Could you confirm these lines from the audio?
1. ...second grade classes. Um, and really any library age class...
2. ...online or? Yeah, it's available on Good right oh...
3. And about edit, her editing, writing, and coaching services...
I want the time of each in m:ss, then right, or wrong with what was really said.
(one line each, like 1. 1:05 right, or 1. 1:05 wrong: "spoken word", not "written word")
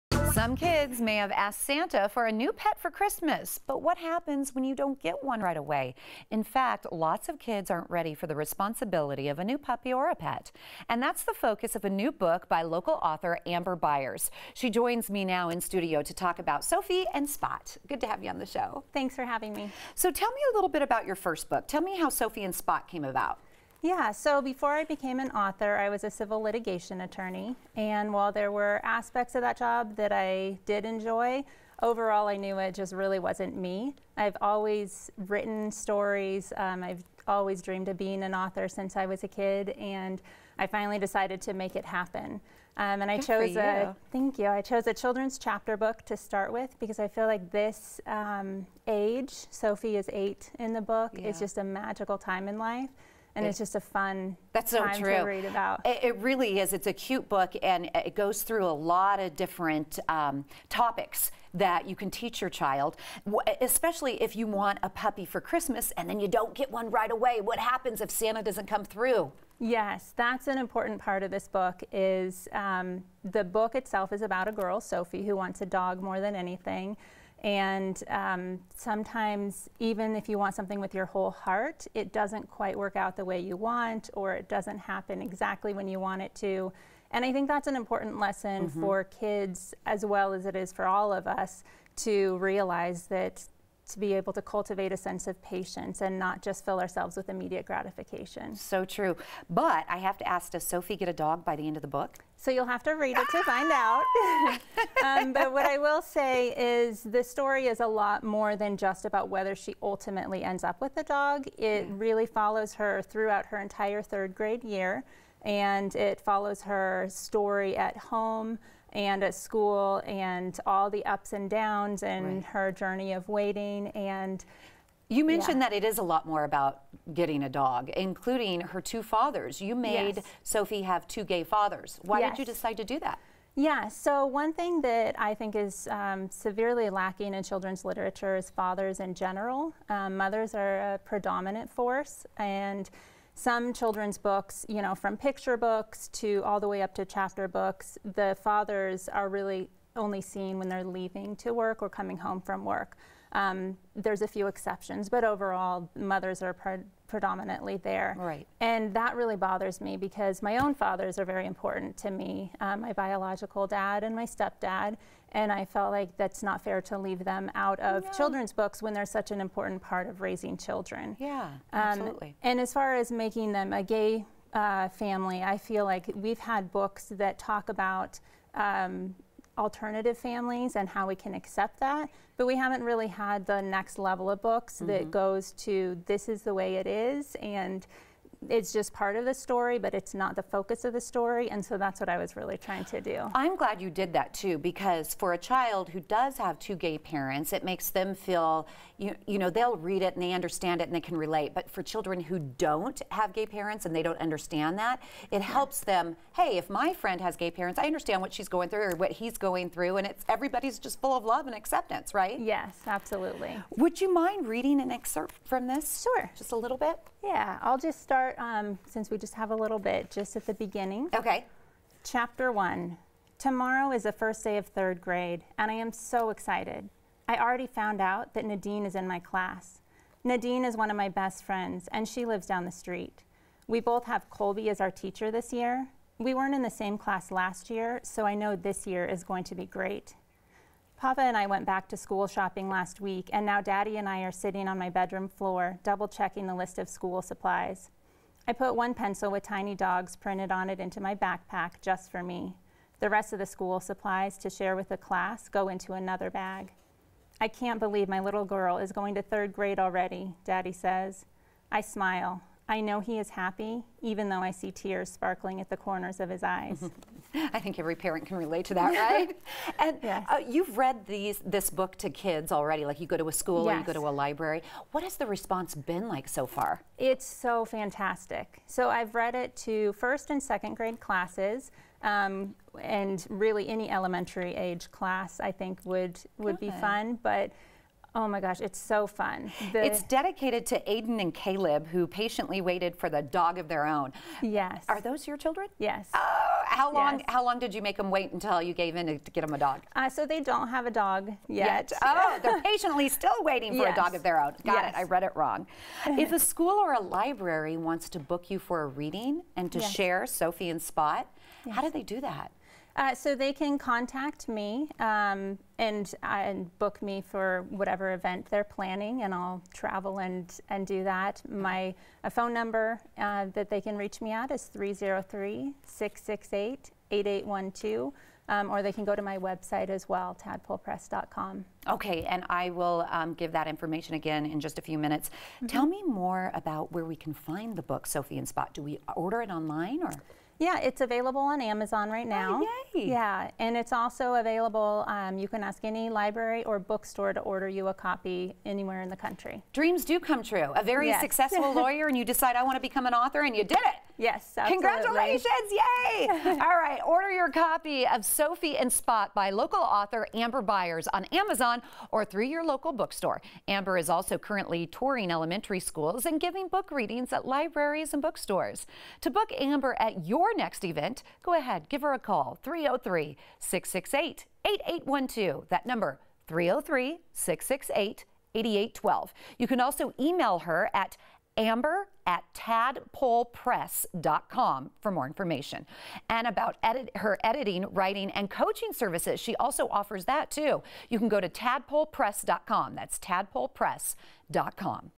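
1. 4:40 wrong: "elementary", not "library"
2. 5:39 wrong: "Amazon", not "Good"
3. 6:26 right.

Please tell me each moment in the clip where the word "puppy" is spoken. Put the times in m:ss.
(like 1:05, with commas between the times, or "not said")
0:09, 1:04.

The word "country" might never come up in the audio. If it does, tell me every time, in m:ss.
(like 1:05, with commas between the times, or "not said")
5:49.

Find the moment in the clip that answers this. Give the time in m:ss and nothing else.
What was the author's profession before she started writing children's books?
0:26.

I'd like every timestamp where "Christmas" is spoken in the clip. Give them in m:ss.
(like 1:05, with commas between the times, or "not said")
0:02, 1:05.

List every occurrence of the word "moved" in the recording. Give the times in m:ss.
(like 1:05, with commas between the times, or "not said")
not said.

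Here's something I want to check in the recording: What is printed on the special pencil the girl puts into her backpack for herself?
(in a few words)
tiny dogs.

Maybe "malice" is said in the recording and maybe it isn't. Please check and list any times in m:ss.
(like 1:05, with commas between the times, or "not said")
not said.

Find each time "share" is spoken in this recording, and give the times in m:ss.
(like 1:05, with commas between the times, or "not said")
4:14, 5:09.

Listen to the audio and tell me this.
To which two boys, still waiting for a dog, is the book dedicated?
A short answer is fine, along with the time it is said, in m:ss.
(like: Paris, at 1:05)
Aiden and Caleb, at 4:50.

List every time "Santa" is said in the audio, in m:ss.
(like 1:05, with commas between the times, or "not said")
0:01, 1:08.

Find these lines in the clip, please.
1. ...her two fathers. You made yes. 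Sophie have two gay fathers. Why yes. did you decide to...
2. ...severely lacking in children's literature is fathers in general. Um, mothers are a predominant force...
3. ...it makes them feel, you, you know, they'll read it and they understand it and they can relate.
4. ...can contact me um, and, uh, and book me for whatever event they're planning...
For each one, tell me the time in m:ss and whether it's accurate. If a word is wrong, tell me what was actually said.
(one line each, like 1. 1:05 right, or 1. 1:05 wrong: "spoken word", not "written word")
1. 2:08 right
2. 2:16 right
3. 3:17 right
4. 5:13 right.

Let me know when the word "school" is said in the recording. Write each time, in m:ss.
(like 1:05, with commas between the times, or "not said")
1:59, 4:01, 4:06, 4:13, 4:33, 5:06, 6:05.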